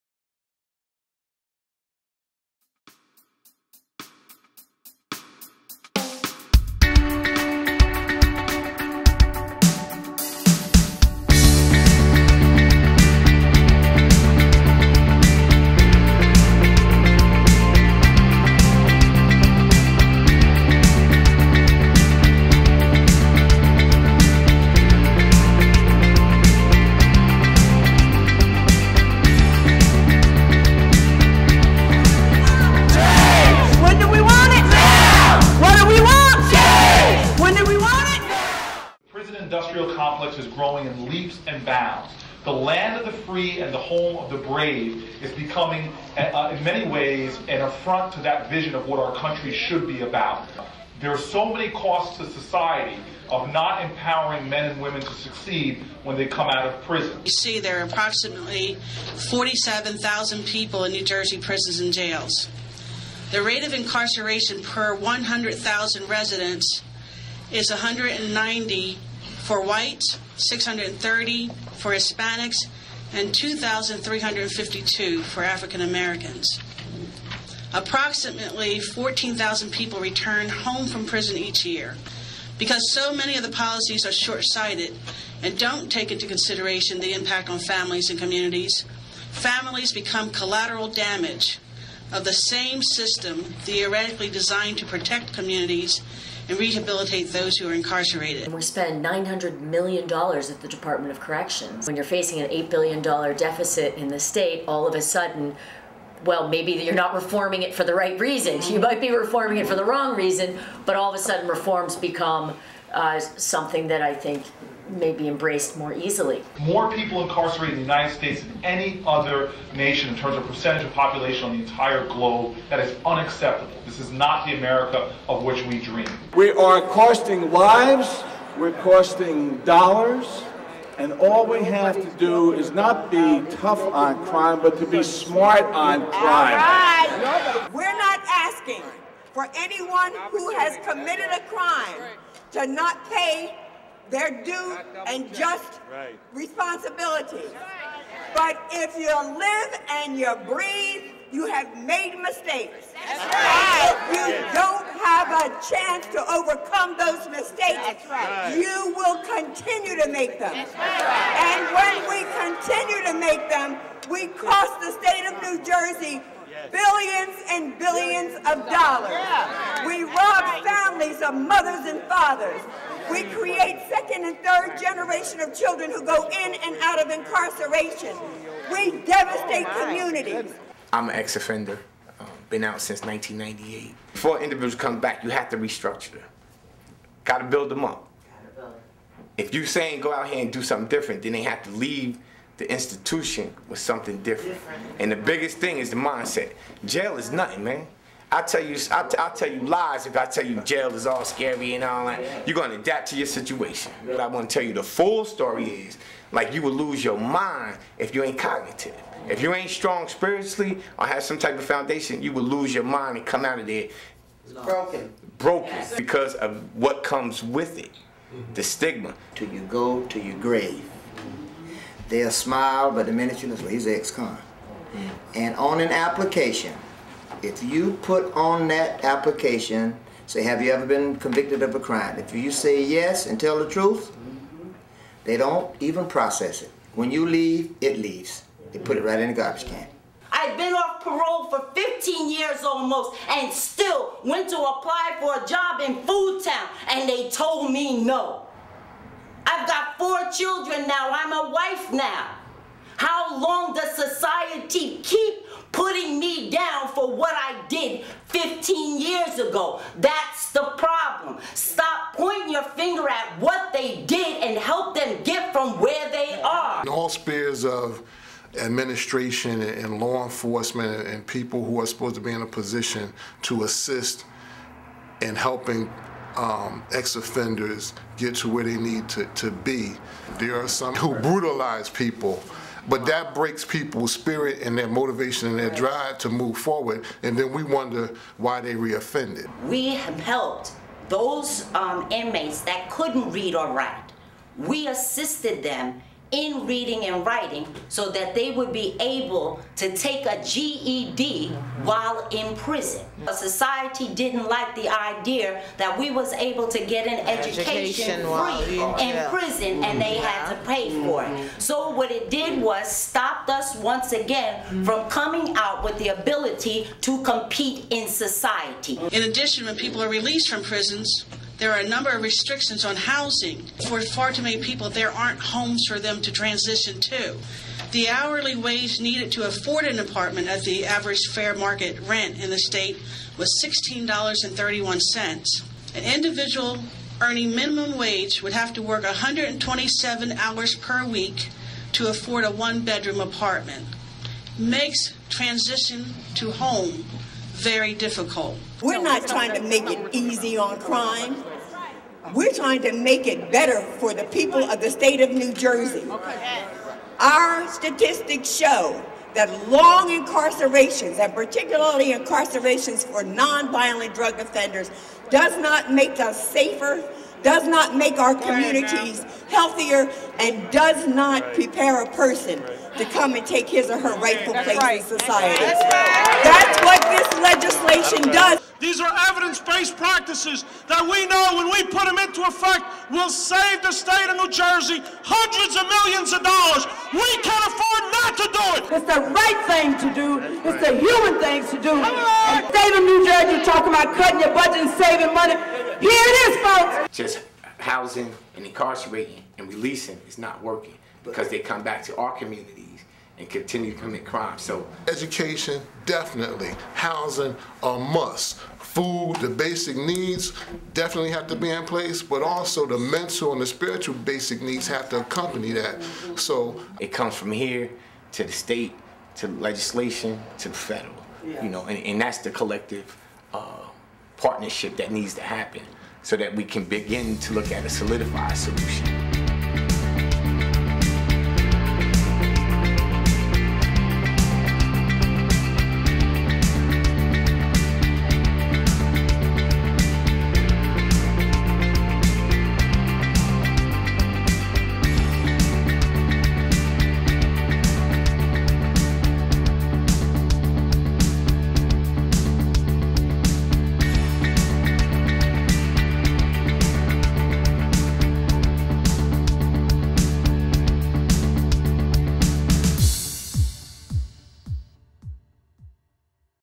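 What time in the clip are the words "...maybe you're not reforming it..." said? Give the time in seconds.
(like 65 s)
106 s.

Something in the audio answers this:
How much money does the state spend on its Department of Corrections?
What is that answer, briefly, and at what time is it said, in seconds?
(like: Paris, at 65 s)
$900 million, at 99 s.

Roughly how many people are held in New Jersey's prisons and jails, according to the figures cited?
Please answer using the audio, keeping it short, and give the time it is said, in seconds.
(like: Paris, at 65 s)
47,000, at 59 s.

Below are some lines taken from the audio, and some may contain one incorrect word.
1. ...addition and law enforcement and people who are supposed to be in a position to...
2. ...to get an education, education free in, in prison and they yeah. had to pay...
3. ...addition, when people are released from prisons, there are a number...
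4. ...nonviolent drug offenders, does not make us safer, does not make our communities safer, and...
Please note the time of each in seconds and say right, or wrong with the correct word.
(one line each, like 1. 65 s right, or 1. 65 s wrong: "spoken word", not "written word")
1. 268 s wrong: "administration", not "addition"
2. 306 s right
3. 319 s right
4. 363 s wrong: "healthier", not "safer".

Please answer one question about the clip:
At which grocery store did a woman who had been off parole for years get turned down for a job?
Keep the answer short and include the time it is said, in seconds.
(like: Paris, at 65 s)
Foodtown, at 246 s.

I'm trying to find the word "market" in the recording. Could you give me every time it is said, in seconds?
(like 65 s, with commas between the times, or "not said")
331 s.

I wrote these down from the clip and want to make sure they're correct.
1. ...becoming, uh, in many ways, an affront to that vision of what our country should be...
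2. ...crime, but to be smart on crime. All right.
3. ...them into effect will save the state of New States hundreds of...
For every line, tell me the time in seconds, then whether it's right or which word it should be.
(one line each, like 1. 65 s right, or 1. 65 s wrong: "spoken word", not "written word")
1. 45 s right
2. 134 s right
3. 382 s wrong: "Jersey", not "States".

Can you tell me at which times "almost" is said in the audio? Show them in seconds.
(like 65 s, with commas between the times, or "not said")
242 s.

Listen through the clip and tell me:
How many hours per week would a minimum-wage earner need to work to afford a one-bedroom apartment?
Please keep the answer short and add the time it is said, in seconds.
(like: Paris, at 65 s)
127, at 339 s.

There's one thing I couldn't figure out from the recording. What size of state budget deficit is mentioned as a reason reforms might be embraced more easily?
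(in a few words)
$8 billion.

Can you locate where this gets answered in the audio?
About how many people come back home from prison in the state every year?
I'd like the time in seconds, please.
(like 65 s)
78 s.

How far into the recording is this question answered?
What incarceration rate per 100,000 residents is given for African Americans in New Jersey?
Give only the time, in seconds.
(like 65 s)
73 s.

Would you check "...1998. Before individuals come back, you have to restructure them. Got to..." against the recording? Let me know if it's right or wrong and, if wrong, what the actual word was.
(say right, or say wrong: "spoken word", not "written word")
right.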